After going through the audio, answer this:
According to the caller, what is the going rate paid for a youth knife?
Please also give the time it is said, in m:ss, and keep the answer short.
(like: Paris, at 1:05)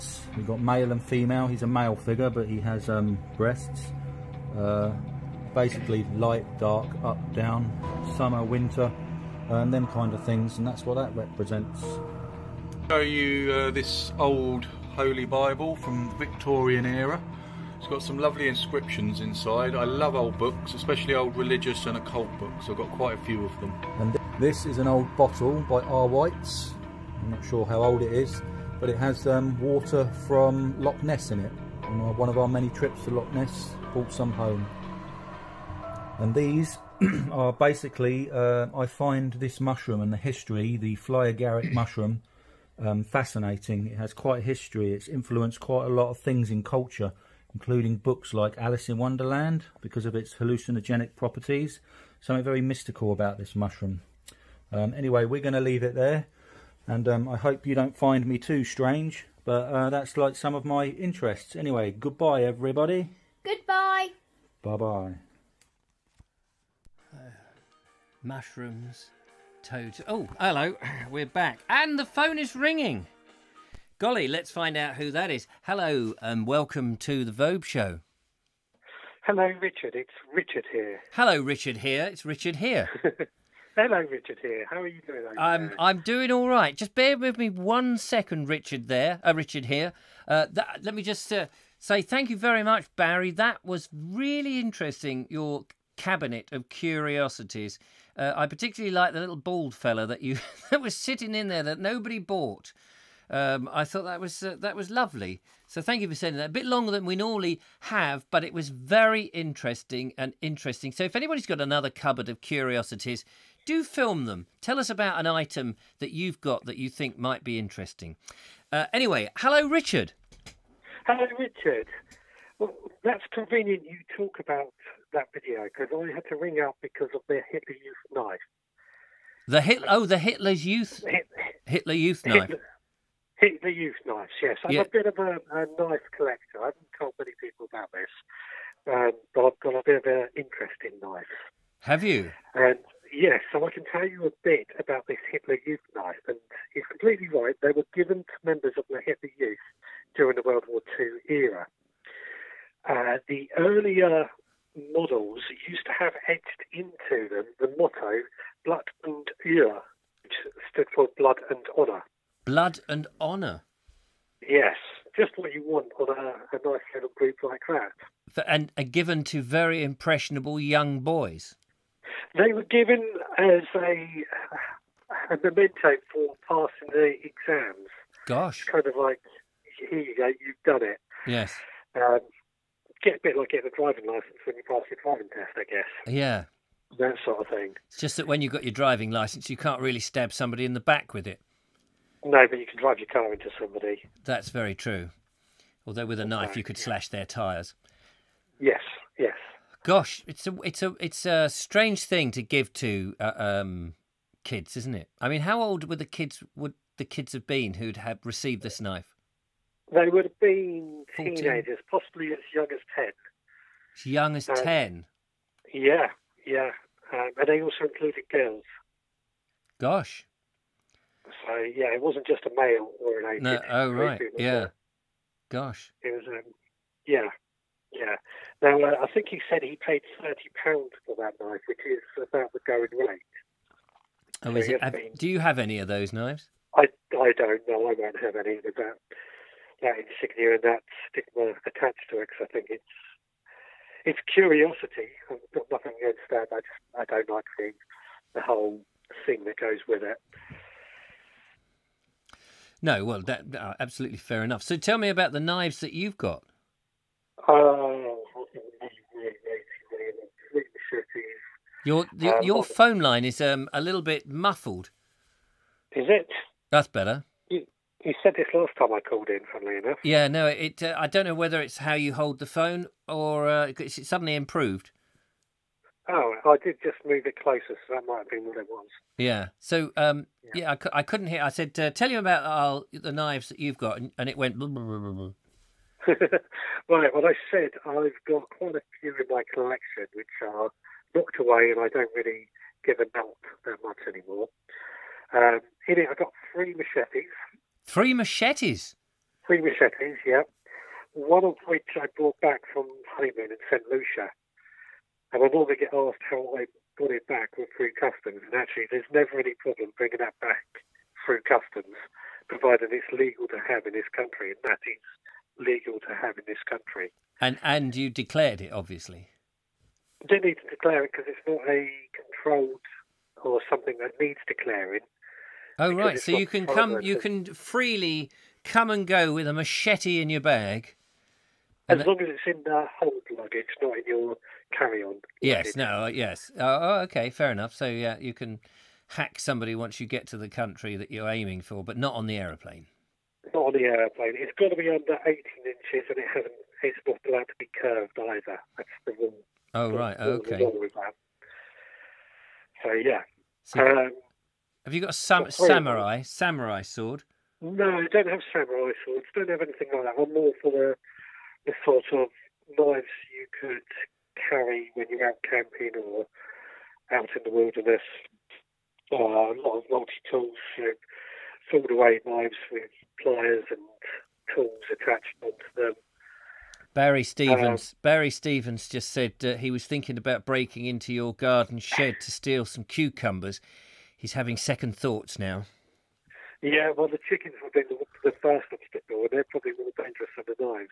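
£30, at 3:50.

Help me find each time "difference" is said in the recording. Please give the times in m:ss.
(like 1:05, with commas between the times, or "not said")
not said.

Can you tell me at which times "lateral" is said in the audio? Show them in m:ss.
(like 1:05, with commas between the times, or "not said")
not said.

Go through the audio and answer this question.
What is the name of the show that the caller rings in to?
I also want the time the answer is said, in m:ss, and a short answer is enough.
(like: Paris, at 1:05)
The Vobe Show, at 1:17.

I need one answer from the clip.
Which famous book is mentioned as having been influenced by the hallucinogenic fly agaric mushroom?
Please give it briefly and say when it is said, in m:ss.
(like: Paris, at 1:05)
Alice in Wonderland, at 0:48.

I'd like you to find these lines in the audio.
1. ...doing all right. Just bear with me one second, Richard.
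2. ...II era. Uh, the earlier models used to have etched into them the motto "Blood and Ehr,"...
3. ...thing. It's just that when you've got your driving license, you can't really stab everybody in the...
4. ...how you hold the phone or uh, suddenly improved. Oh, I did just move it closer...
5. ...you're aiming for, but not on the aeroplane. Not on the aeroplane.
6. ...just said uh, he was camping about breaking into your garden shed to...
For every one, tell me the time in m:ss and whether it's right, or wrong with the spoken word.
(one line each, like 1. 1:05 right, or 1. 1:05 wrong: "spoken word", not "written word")
1. 1:25 right
2. 2:30 right
3. 3:07 wrong: "somebody", not "everybody"
4. 4:31 right
5. 5:41 right
6. 6:18 wrong: "thinking", not "camping".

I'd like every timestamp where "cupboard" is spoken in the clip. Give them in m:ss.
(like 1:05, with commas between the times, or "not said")
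1:51.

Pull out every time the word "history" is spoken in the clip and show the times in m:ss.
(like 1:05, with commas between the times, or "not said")
0:40, 0:44.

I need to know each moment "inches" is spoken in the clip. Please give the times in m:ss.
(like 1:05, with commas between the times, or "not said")
5:45.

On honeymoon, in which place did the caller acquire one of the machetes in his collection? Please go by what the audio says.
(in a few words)
St. Lucia.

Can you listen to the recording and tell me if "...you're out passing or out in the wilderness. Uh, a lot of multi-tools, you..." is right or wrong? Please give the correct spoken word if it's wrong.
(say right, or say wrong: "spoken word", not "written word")
wrong: "camping", not "passing".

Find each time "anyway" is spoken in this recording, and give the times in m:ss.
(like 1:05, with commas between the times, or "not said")
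0:54, 1:01, 1:58.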